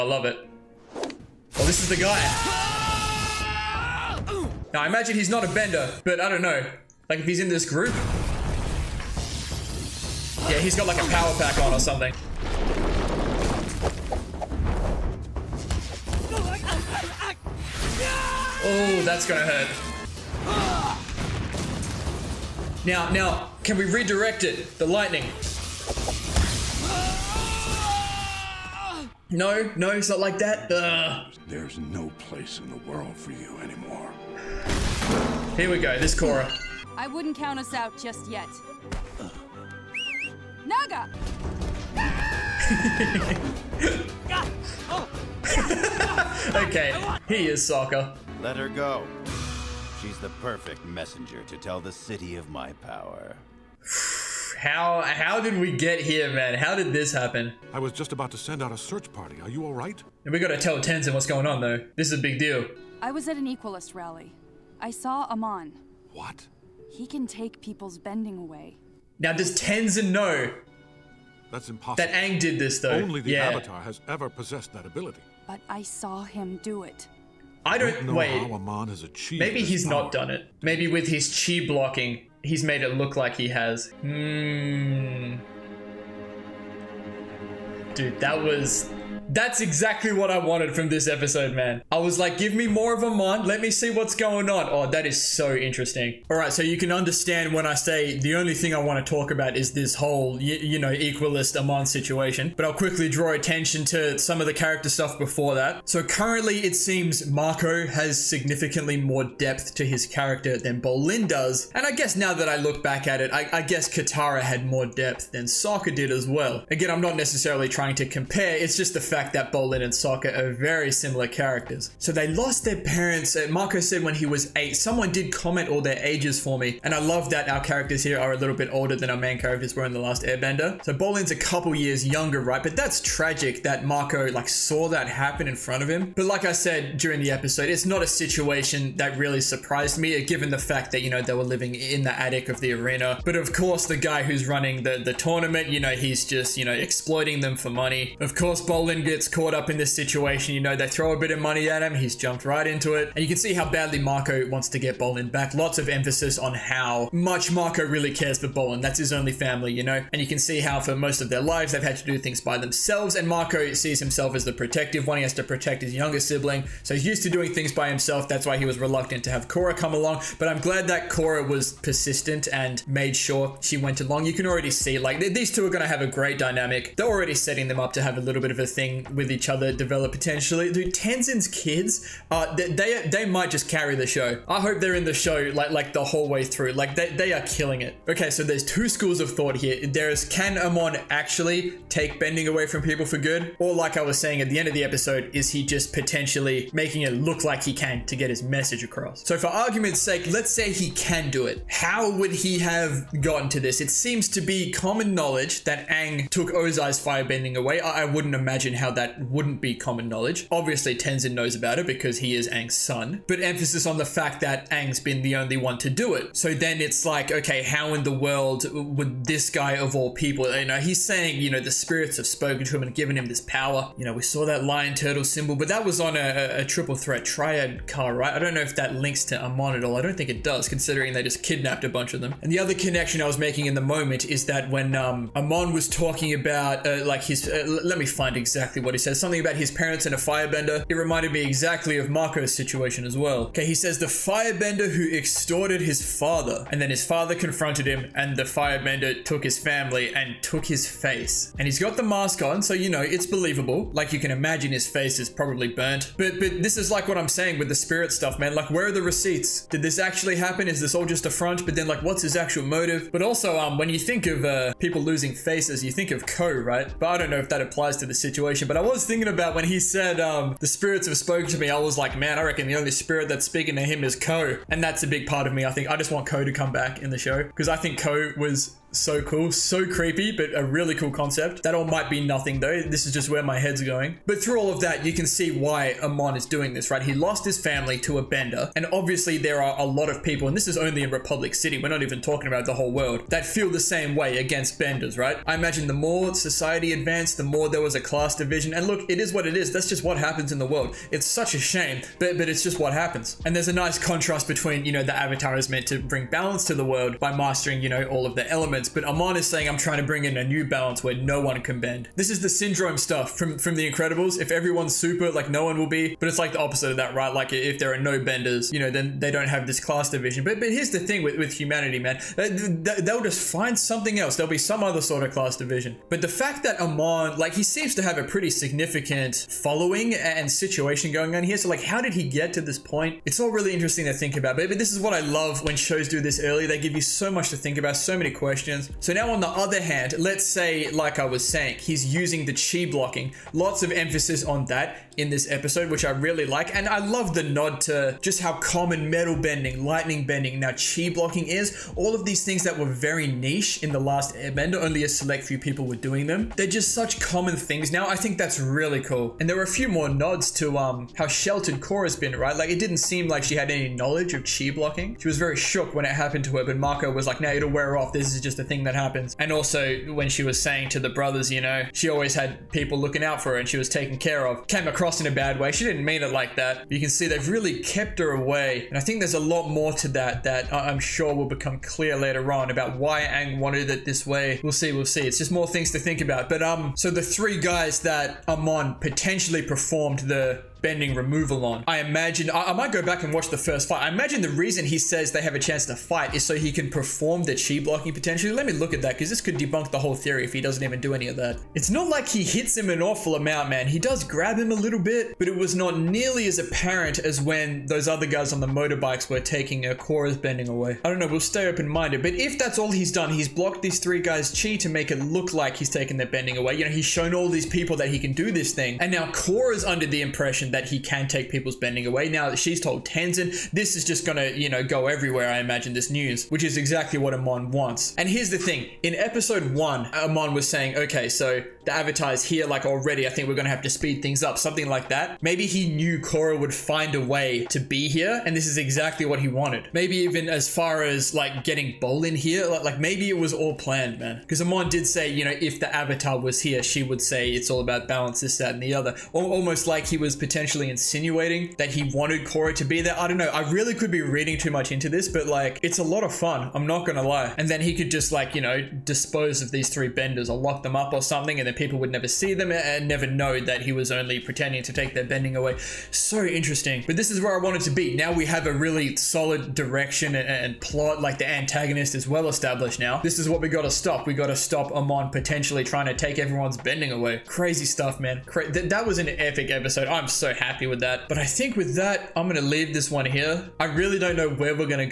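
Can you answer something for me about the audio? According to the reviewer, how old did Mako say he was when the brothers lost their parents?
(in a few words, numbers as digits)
8.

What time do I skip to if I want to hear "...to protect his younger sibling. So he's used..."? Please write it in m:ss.
2:45.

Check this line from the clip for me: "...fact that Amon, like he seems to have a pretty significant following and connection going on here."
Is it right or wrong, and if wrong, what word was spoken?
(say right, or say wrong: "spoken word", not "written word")
wrong: "situation", not "connection".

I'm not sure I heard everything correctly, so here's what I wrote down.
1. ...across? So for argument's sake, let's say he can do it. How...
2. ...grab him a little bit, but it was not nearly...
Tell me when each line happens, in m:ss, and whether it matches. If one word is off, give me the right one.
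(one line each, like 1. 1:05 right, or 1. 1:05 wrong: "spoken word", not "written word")
1. 3:18 right
2. 6:44 right.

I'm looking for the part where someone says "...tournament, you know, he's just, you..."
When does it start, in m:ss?
2:25.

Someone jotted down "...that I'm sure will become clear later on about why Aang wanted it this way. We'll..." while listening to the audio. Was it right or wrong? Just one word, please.
right.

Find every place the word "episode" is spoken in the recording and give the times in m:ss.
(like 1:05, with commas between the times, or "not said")
1:31, 2:17, 3:14, 5:45, 7:09, 7:59.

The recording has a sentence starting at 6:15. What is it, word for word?
She didn't mean it like that.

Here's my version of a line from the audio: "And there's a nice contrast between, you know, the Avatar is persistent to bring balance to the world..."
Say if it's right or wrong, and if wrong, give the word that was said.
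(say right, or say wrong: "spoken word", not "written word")
wrong: "meant", not "persistent".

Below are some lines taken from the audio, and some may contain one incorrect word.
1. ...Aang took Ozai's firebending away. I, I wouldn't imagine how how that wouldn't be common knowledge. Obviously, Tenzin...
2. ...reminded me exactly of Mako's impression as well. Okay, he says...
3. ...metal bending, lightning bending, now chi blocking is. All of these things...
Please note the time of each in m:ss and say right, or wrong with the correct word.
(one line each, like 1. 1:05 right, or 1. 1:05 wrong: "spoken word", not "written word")
1. 3:25 right
2. 4:00 wrong: "situation", not "impression"
3. 5:49 right.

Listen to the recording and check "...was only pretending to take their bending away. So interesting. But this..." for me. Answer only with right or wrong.
right.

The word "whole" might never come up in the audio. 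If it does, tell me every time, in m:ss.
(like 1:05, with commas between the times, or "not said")
1:39, 3:06, 4:52, 6:39.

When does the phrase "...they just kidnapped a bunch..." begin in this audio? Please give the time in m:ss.
3:51.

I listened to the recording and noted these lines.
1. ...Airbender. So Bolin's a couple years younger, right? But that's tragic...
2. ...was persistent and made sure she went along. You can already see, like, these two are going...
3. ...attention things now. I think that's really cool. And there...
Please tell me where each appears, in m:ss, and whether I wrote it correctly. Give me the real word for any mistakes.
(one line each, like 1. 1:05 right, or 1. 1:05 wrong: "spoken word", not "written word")
1. 2:10 right
2. 2:51 right
3. 5:57 wrong: "common", not "attention".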